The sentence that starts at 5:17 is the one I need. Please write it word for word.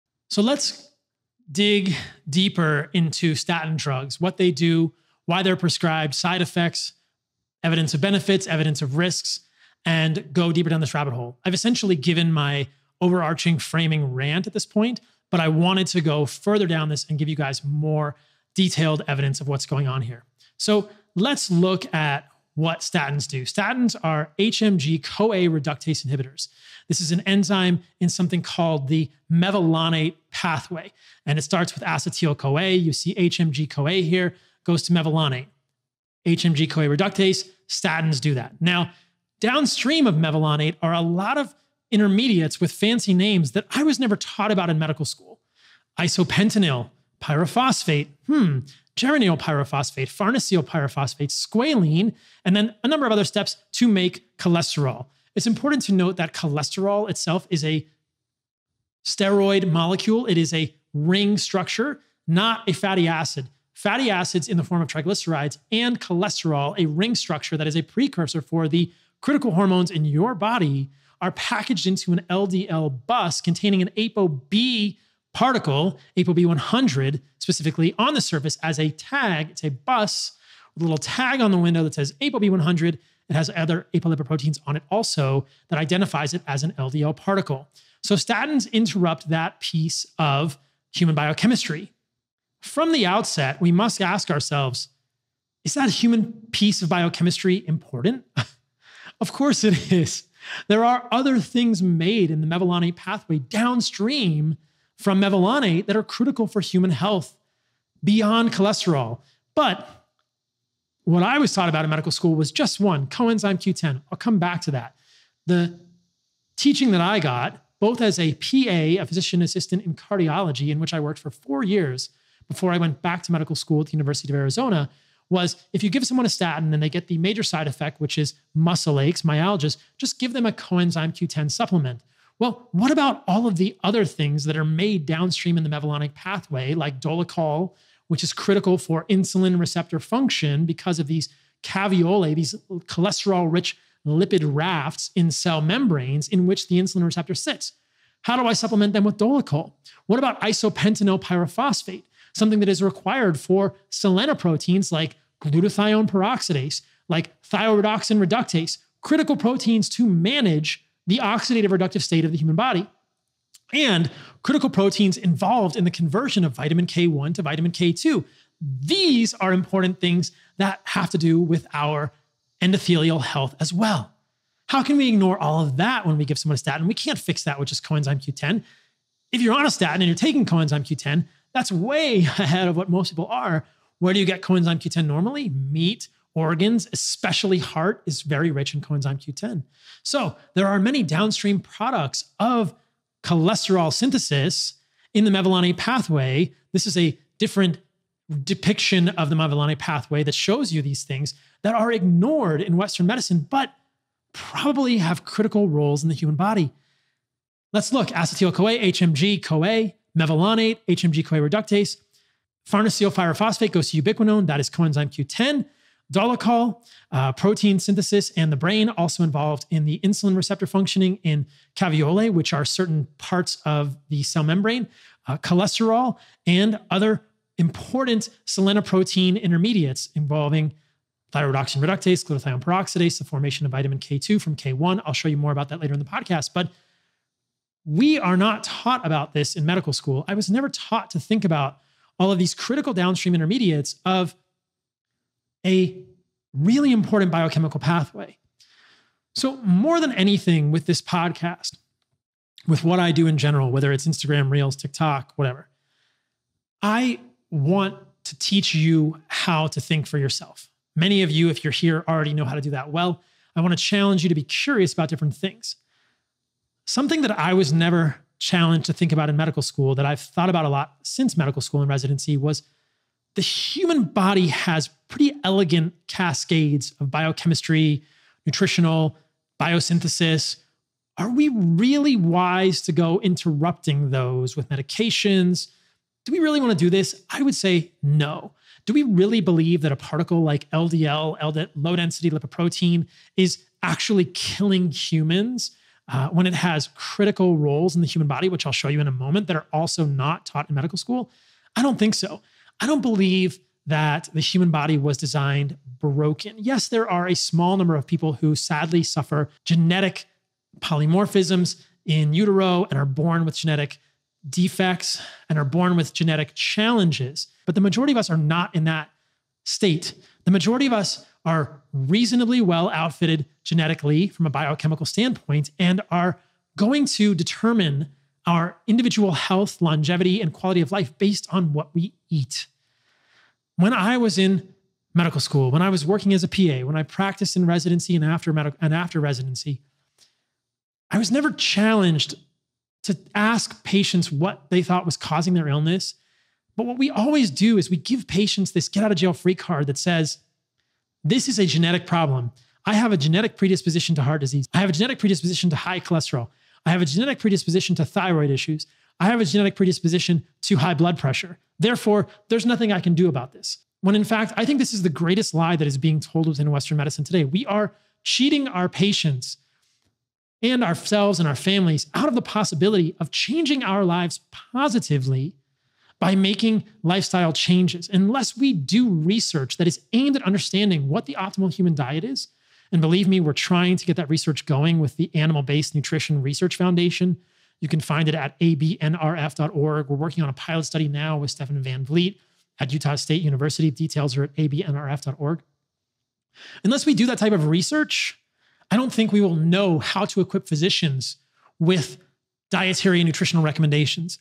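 But the majority of us are not in that state.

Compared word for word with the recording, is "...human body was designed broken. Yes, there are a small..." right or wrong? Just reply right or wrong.
right.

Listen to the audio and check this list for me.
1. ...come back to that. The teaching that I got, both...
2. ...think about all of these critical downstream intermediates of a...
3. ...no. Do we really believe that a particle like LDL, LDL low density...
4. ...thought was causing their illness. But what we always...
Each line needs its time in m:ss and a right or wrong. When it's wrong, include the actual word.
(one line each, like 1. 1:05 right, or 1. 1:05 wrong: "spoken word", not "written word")
1. 1:54 right
2. 4:01 right
3. 4:48 right
4. 5:44 right.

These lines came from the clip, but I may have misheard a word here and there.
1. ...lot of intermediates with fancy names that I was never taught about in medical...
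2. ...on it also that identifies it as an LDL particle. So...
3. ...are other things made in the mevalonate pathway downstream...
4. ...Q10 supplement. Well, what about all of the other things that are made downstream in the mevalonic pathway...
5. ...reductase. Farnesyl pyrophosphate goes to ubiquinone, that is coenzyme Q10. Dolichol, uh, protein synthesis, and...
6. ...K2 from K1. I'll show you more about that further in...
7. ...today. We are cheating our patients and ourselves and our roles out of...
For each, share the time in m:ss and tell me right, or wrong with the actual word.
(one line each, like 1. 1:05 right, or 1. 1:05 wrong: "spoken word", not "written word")
1. 0:41 right
2. 1:24 right
3. 1:40 right
4. 2:11 right
5. 3:31 right
6. 3:53 wrong: "later", not "further"
7. 6:07 wrong: "families", not "roles".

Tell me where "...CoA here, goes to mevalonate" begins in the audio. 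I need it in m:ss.
0:33.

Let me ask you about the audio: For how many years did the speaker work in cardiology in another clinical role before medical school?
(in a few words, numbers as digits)
4.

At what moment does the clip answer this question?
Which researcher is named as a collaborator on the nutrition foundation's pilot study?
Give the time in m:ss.
6:31.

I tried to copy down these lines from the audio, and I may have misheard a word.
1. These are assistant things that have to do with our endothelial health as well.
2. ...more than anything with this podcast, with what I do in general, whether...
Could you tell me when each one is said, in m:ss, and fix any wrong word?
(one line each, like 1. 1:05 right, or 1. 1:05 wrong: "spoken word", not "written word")
1. 2:48 wrong: "important", not "assistant"
2. 4:09 right.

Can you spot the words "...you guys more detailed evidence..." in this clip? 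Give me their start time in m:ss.
0:17.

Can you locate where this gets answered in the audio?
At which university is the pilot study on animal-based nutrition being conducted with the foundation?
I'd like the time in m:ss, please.
6:32.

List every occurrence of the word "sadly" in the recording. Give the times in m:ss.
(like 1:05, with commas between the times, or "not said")
5:08.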